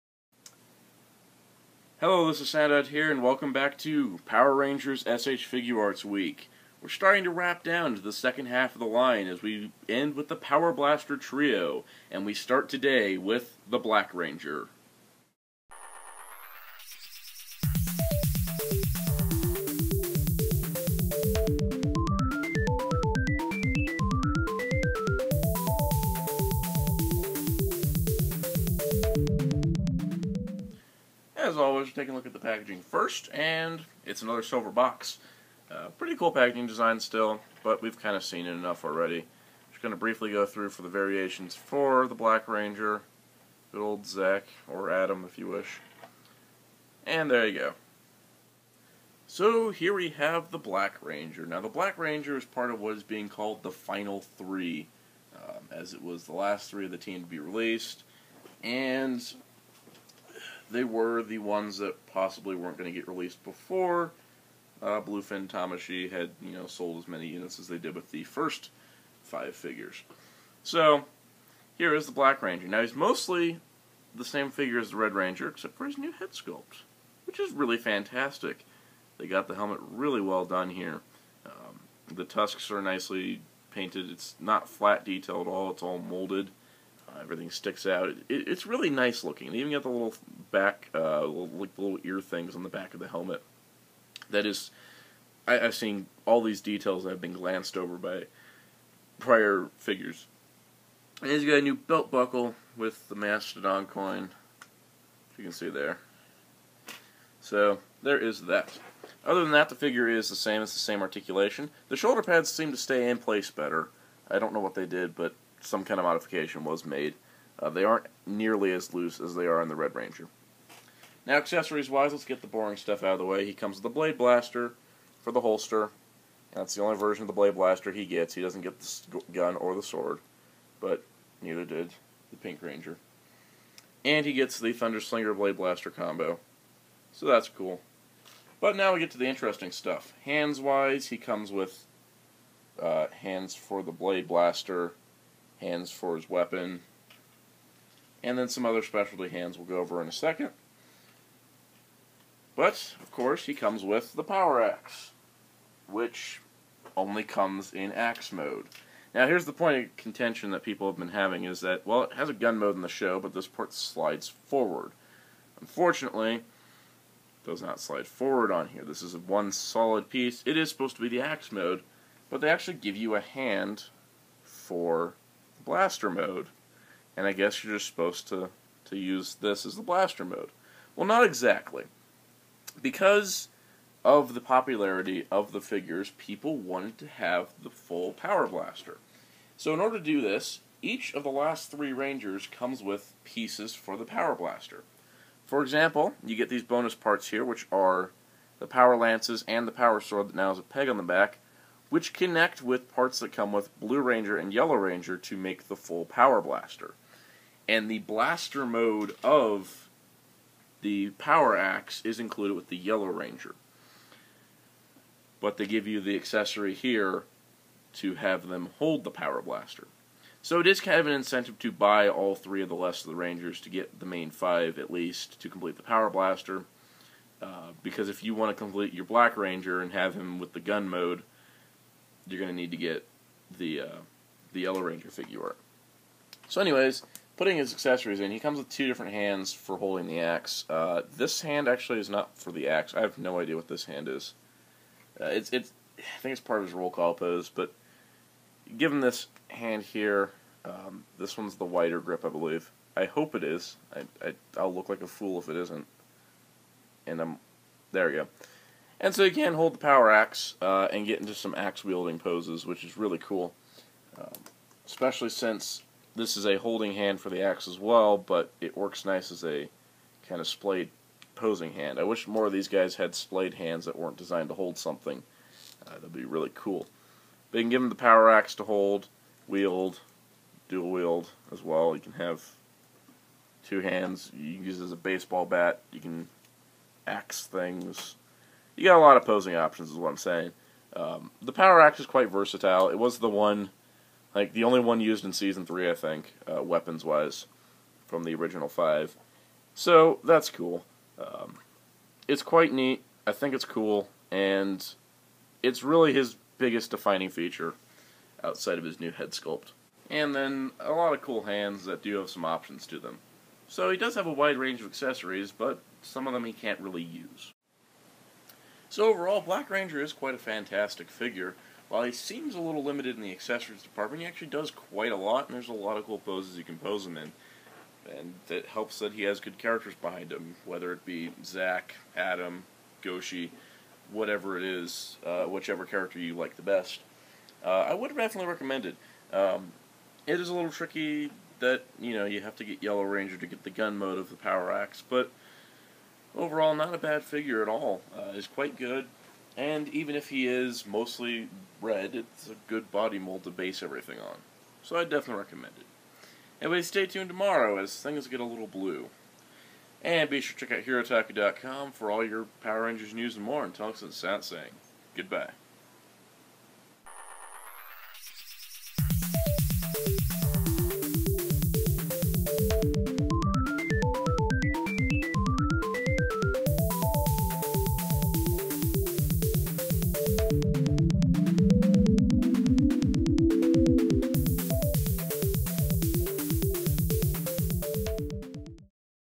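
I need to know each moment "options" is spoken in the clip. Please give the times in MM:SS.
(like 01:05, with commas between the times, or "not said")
04:49, 05:12.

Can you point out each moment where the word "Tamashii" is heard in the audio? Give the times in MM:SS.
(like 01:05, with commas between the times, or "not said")
01:05.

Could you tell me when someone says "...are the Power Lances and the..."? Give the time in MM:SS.
03:17.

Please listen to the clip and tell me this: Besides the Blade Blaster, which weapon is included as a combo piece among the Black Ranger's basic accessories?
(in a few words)
Thunder Slinger.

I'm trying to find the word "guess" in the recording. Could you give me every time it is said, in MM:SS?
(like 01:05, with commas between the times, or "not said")
02:57.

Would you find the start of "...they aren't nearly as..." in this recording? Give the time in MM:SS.
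01:57.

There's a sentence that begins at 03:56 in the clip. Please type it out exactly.
So anyways, putting his accessories in, he comes with two different hands for holding the axe.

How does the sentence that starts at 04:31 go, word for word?
I wish more of these guys had splayed hands that weren't designed to hold something.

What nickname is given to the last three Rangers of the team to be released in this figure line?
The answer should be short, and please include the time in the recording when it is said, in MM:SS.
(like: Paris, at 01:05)
Final Three, at 00:53.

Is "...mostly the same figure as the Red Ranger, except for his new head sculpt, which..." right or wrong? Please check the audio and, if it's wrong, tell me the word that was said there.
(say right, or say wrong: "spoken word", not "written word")
right.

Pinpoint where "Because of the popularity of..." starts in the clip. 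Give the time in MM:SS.
03:02.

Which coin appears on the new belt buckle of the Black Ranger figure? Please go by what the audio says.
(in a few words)
Mastodon coin.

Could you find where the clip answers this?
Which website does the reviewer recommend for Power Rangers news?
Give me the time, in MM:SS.
06:00.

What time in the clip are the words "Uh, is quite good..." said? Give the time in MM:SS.
05:48.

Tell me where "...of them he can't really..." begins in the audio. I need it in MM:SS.
05:16.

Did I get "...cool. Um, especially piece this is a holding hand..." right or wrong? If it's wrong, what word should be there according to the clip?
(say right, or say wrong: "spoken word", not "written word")
wrong: "since", not "piece".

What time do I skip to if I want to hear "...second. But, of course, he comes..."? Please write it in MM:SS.
02:30.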